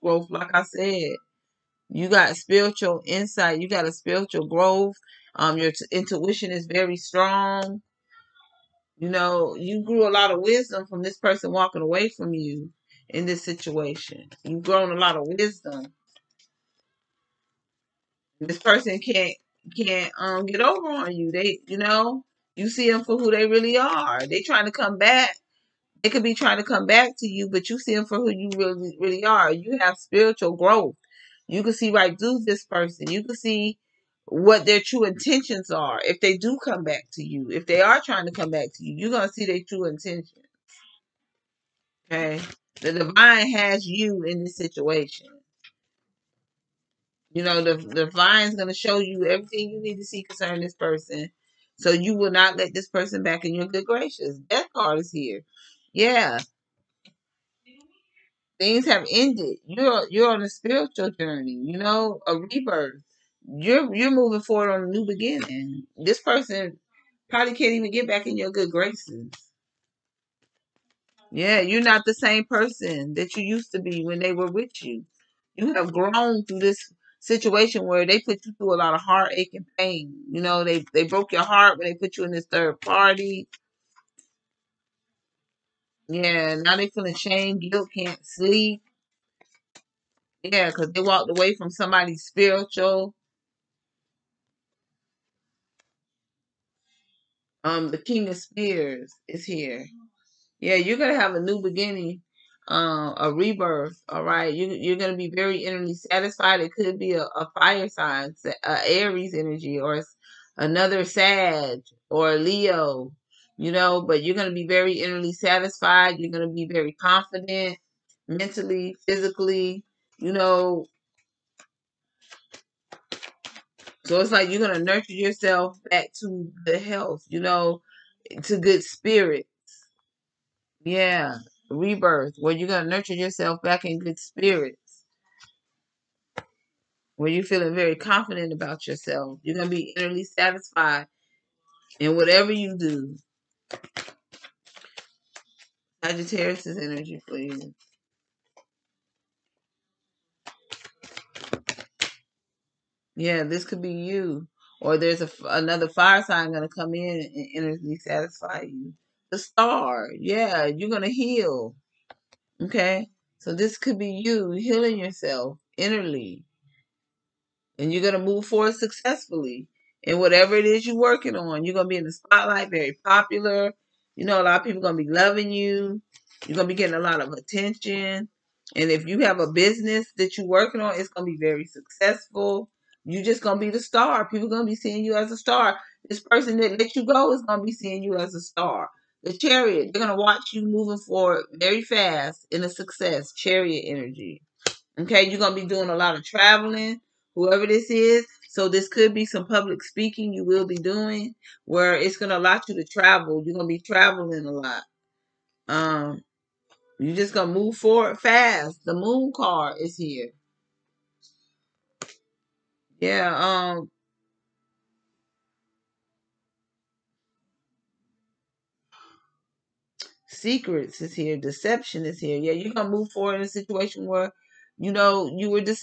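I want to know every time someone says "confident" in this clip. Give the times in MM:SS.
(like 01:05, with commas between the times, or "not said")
01:56, 02:17.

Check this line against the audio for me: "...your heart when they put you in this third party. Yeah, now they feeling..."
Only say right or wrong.
right.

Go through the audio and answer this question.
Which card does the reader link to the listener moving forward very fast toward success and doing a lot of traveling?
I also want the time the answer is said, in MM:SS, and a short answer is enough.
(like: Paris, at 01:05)
The Chariot, at 03:09.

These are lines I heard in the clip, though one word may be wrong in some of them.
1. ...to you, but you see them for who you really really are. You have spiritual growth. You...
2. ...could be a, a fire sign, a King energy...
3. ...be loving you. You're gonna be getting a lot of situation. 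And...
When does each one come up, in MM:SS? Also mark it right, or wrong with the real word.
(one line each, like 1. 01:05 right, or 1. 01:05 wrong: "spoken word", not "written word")
1. 00:27 right
2. 01:46 wrong: "Aries", not "King"
3. 02:54 wrong: "attention", not "situation".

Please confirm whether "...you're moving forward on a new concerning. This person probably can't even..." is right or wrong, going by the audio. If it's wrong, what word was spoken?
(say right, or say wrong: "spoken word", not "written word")
wrong: "beginning", not "concerning".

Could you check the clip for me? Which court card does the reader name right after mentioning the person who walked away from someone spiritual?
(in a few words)
King of Spears.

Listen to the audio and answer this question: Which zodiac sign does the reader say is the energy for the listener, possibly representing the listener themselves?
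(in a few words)
Sagittarius.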